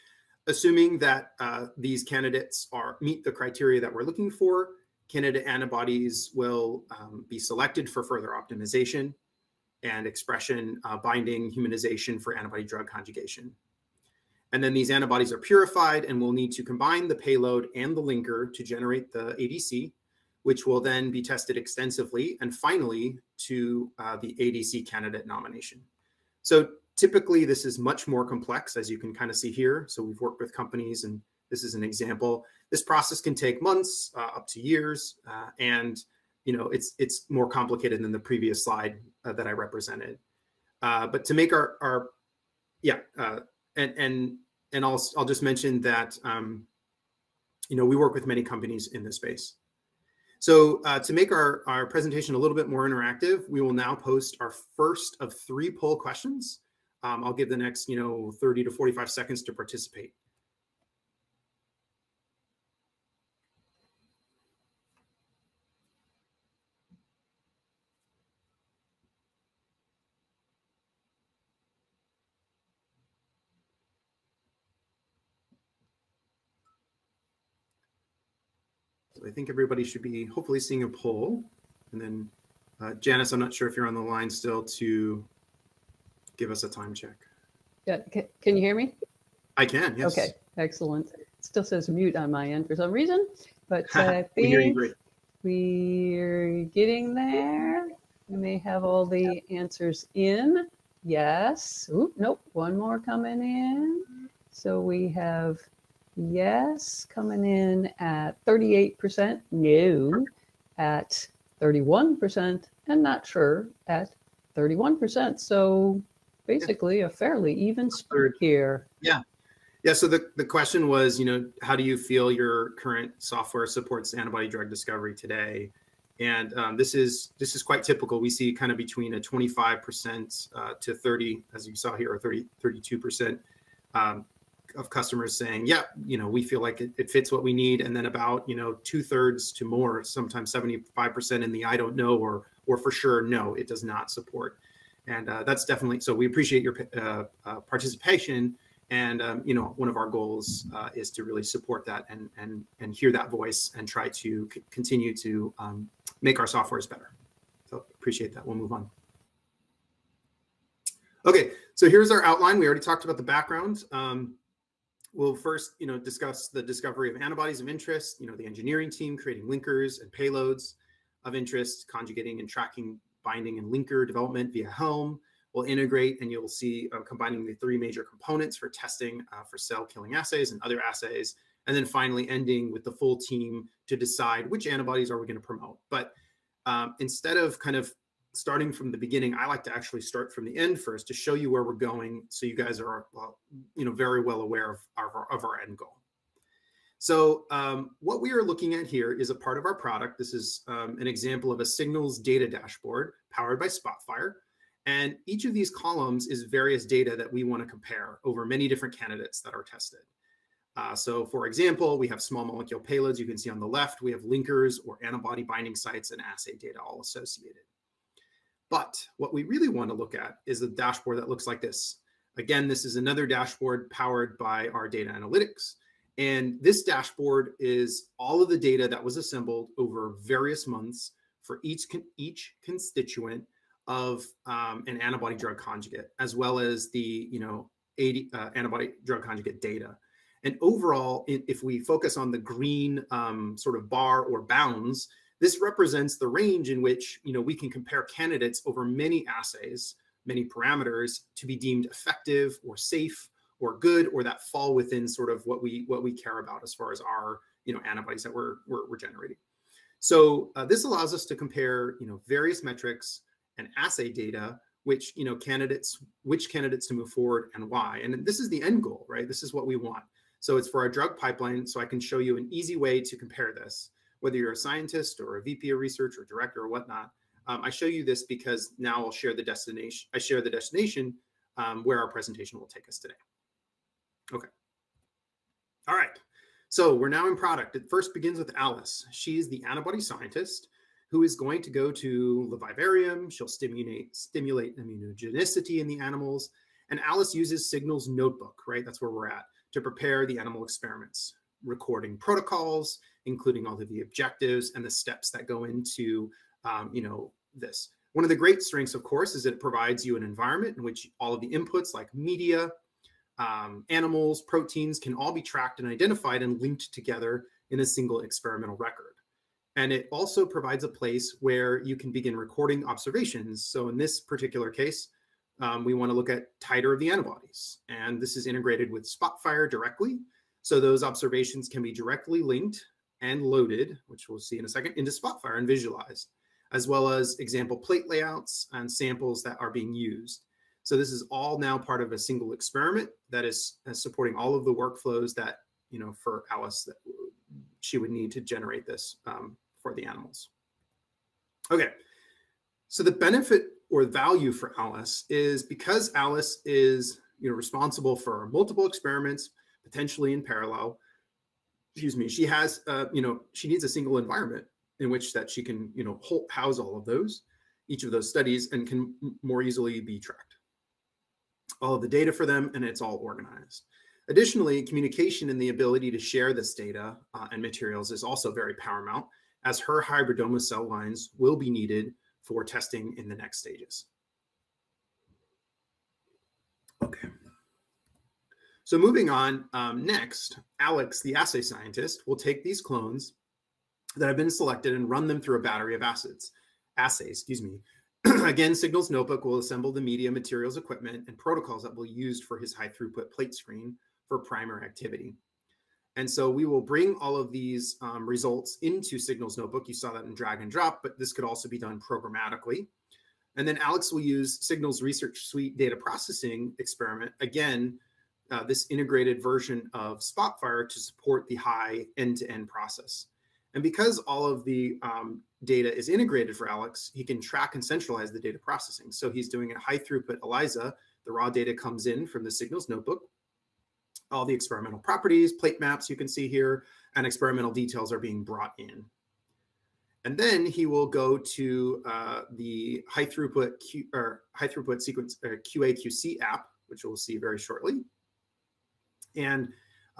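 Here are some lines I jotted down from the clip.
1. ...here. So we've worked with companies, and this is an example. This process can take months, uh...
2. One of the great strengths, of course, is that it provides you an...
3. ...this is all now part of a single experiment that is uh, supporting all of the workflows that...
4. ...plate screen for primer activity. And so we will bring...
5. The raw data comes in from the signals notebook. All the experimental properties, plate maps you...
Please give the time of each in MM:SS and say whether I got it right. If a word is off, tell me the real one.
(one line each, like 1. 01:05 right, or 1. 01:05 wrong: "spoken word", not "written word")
1. 00:29 right
2. 05:08 right
3. 05:40 right
4. 06:43 right
5. 07:11 right.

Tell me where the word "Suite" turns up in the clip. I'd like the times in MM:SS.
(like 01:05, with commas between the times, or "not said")
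06:55.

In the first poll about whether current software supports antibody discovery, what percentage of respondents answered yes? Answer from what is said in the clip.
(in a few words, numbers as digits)
38%.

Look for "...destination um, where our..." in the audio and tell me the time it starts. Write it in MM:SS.
04:40.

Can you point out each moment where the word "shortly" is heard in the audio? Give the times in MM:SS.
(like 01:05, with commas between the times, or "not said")
07:27.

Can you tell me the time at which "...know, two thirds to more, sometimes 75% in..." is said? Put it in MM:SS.
02:18.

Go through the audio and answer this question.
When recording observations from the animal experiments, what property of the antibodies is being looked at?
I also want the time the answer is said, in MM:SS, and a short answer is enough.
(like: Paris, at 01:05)
Titer, at 05:26.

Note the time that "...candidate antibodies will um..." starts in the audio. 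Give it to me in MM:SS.
00:05.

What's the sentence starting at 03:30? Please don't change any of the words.
Uh, so for example, we have small molecule payloads.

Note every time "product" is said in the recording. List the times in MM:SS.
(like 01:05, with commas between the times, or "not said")
03:19, 04:47.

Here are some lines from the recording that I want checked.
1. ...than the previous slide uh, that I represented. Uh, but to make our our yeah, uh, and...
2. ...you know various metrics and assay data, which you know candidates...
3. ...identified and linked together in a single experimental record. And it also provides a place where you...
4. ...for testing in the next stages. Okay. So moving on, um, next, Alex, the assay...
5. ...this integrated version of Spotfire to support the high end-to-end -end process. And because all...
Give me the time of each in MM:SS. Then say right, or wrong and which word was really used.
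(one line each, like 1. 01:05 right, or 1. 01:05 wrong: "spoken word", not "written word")
1. 00:38 right
2. 04:21 right
3. 05:15 right
4. 06:22 right
5. 06:58 right.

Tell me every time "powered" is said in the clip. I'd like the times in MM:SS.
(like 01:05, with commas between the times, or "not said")
03:23, 03:43.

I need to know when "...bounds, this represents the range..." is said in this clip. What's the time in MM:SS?
04:04.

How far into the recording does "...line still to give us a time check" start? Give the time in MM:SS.
01:24.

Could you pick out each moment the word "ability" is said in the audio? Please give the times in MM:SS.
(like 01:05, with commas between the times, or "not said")
06:15.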